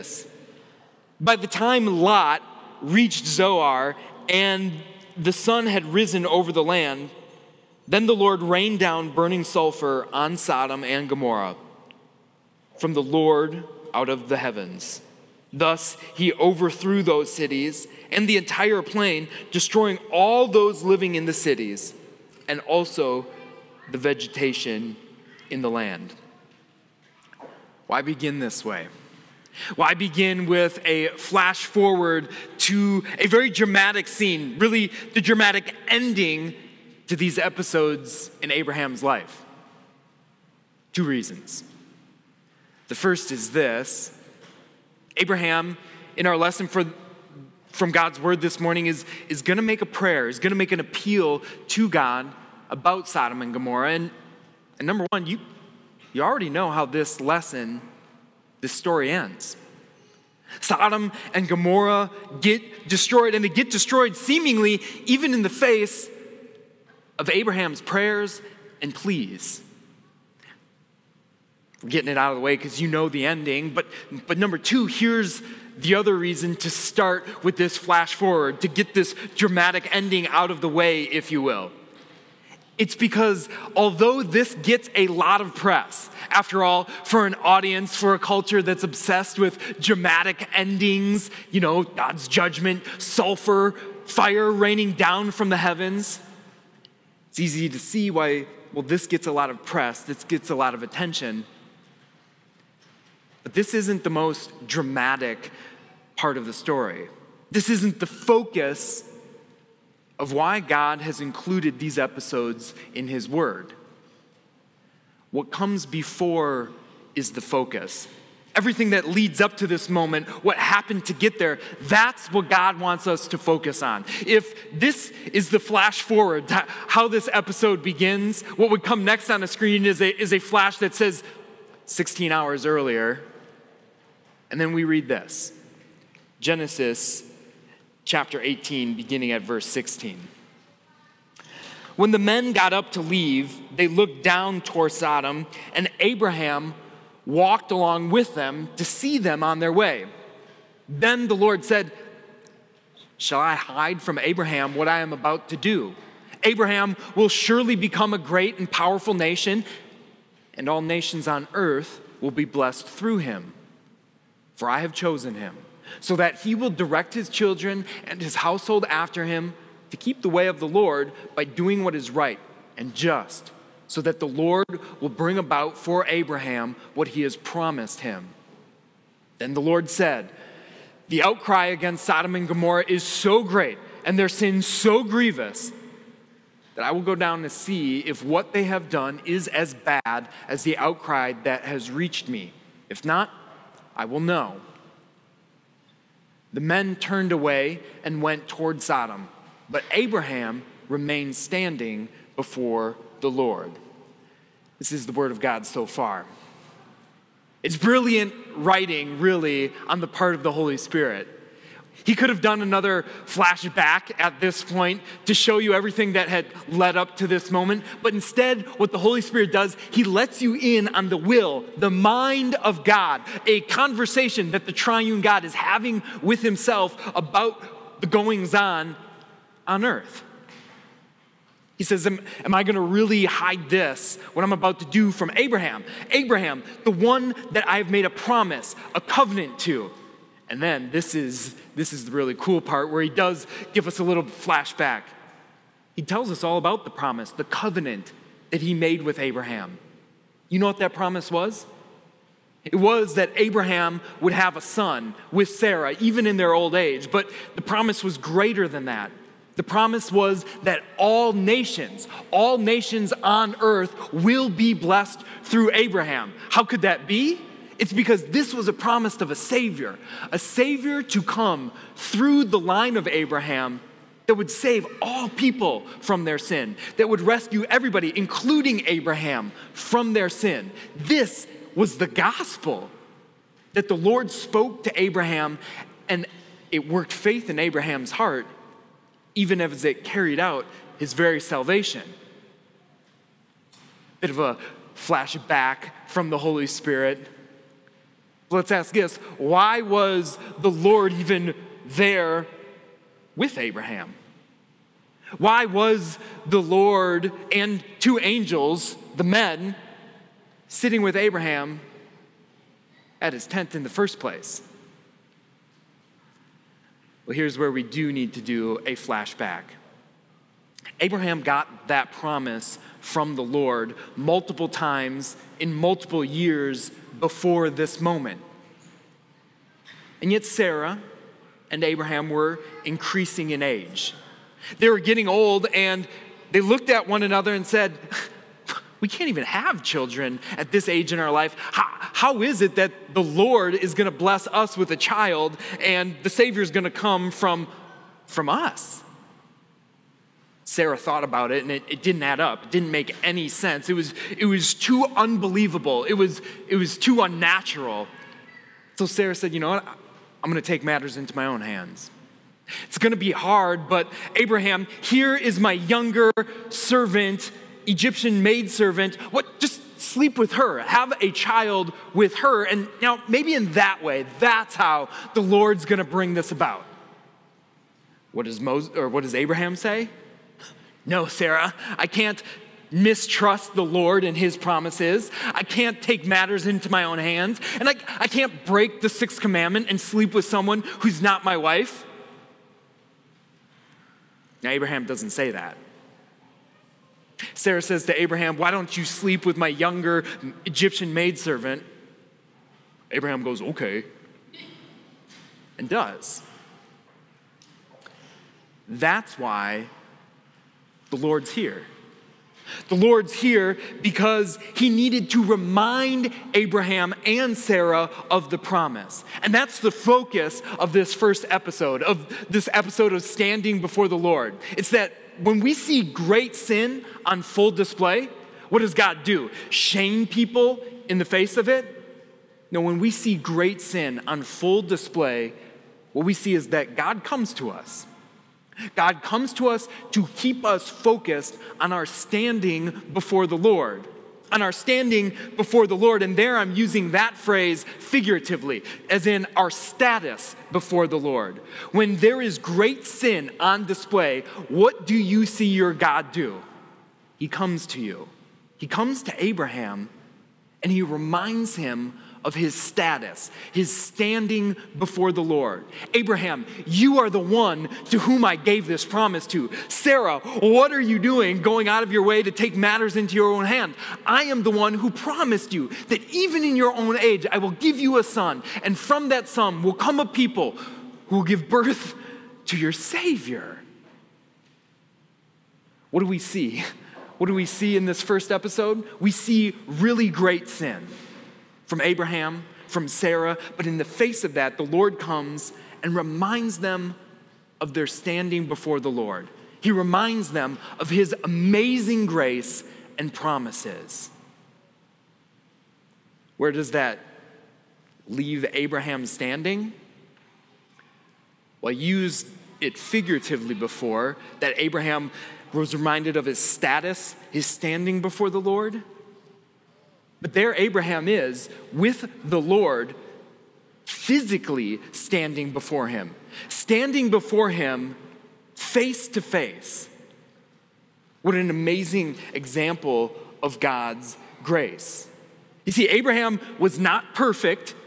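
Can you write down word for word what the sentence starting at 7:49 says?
Sarah, what are you doing going out of your way to take matters into your own hand?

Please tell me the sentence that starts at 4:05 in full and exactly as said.
He tells us all about the promise, the covenant that he made with Abraham.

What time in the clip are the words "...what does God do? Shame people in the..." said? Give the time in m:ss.
7:08.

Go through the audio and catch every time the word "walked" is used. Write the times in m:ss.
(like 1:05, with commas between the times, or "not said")
2:27.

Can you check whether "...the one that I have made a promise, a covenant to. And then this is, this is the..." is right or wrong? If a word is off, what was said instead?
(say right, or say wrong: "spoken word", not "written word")
right.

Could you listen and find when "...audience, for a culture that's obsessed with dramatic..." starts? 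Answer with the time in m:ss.
1:27.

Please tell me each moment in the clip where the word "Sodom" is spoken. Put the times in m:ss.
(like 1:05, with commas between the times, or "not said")
0:10, 0:53, 1:00, 2:24, 3:02, 3:18.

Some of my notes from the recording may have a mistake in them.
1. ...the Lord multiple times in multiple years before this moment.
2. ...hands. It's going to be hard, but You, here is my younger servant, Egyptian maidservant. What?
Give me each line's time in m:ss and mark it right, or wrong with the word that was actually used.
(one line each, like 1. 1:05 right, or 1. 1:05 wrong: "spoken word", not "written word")
1. 5:23 right
2. 6:01 wrong: "Abraham", not "You".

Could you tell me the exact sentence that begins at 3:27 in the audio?
It's brilliant writing, really, on the part of the Holy Spirit.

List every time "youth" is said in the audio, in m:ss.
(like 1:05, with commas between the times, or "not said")
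not said.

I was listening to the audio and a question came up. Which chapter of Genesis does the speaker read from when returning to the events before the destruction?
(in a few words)
Chapter 18.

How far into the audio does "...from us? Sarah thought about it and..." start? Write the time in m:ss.
5:48.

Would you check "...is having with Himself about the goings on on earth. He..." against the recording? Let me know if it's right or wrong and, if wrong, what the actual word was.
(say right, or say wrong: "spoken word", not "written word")
right.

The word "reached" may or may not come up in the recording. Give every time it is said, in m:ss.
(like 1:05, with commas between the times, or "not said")
0:02, 3:11.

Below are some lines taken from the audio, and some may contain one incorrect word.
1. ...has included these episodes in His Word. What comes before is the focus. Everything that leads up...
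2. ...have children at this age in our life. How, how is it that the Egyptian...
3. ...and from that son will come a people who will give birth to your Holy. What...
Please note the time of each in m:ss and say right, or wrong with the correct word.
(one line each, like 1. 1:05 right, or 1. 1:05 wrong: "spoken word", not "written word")
1. 1:51 right
2. 5:39 wrong: "Lord", not "Egyptian"
3. 7:58 wrong: "Savior", not "Holy".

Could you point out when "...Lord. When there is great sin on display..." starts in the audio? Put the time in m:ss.
7:31.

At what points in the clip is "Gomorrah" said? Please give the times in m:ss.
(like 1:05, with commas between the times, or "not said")
0:11, 0:53, 1:01, 3:02.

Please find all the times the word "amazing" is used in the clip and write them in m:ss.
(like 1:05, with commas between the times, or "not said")
8:21, 8:51.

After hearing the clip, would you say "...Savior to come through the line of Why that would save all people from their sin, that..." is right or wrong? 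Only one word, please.
wrong.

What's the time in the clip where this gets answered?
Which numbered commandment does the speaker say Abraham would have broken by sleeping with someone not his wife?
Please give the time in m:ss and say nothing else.
6:29.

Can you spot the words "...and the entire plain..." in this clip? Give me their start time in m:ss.
0:18.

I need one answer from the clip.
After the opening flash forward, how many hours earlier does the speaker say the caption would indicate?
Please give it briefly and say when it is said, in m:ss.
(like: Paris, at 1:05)
16 hours, at 2:11.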